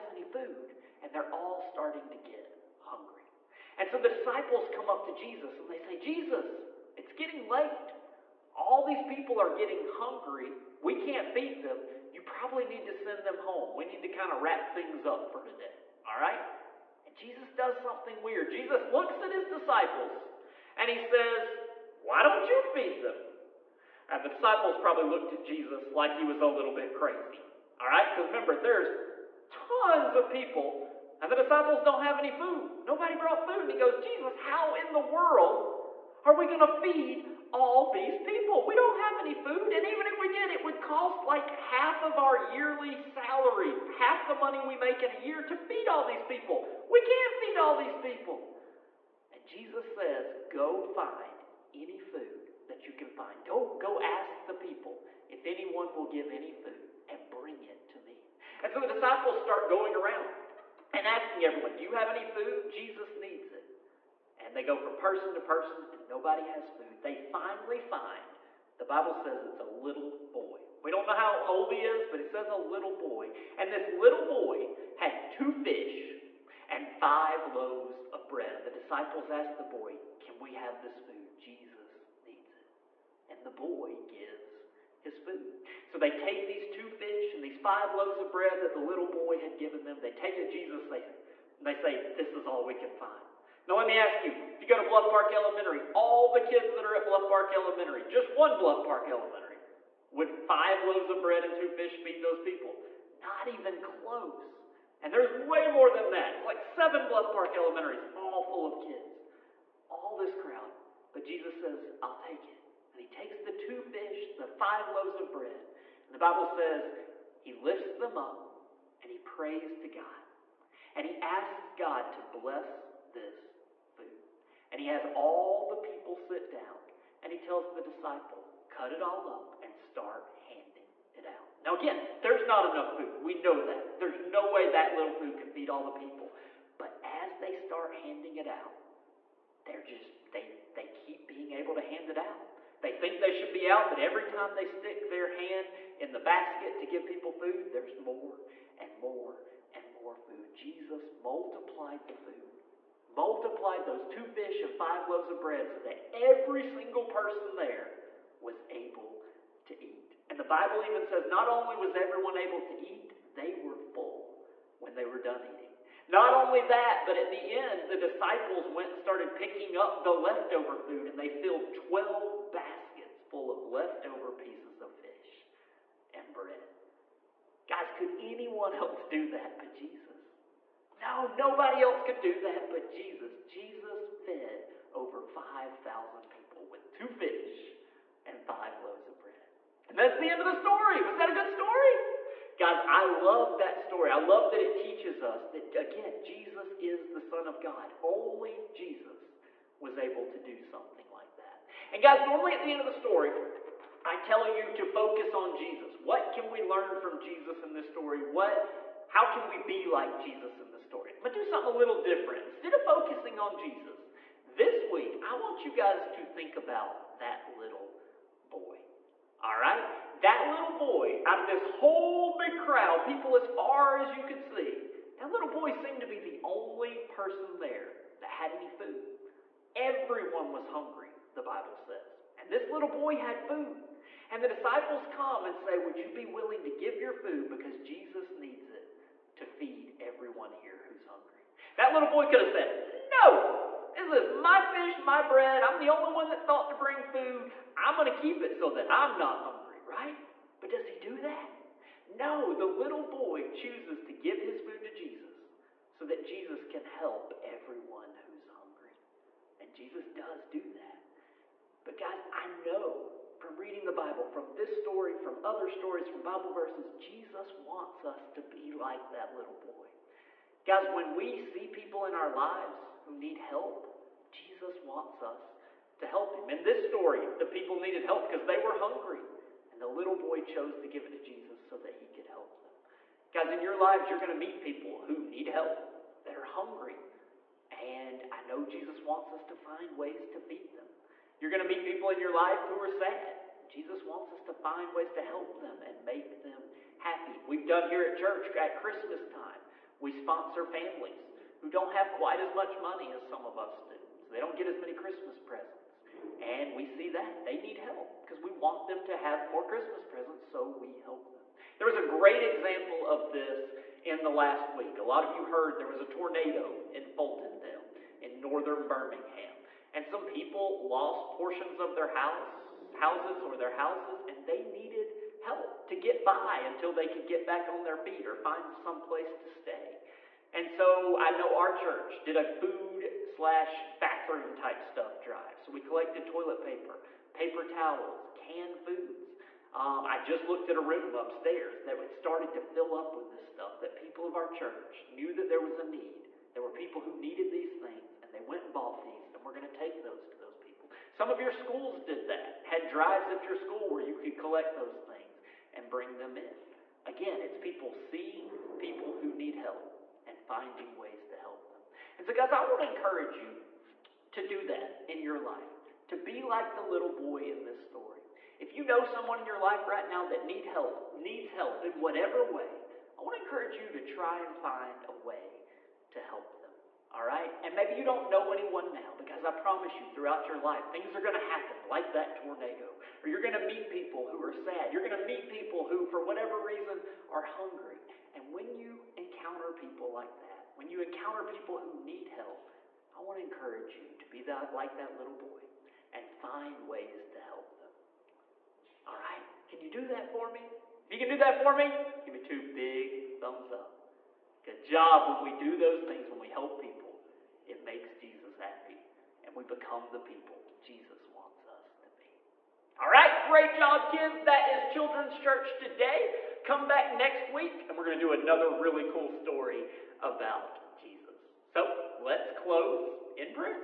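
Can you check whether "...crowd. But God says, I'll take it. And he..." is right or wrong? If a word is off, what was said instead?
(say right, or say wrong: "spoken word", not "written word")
wrong: "Jesus", not "God".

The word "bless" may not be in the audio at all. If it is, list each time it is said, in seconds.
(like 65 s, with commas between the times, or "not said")
122 s.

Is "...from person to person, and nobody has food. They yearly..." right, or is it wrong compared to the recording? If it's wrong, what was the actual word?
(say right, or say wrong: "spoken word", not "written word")
wrong: "finally", not "yearly".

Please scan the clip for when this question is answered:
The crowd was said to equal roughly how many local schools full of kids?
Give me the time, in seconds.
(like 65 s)
106 s.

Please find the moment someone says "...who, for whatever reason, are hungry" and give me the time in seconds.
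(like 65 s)
385 s.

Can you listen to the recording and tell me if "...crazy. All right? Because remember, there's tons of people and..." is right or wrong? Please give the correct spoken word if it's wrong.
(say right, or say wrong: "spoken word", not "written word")
right.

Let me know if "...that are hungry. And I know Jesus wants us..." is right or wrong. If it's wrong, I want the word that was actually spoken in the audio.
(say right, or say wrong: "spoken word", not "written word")
right.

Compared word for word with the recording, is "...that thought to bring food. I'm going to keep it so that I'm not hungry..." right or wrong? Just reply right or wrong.
right.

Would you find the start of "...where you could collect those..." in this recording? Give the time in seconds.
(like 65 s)
353 s.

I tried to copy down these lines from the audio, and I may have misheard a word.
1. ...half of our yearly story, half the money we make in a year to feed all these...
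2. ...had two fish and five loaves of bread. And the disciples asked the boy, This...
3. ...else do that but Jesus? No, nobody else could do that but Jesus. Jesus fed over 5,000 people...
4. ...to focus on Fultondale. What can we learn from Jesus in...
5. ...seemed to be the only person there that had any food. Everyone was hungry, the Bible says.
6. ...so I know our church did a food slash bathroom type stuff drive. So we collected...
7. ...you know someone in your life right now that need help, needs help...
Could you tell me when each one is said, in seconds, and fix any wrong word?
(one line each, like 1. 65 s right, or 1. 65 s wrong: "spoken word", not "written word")
1. 41 s wrong: "salary", not "story"
2. 74 s wrong: "Can", not "This"
3. 178 s right
4. 204 s wrong: "Jesus", not "Fultondale"
5. 225 s right
6. 330 s right
7. 368 s right.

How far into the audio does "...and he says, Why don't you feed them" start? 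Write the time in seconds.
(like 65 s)
20 s.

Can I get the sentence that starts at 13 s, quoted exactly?
We need to kind of wrap things up for today.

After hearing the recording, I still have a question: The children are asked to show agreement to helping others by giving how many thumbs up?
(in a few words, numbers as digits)
2.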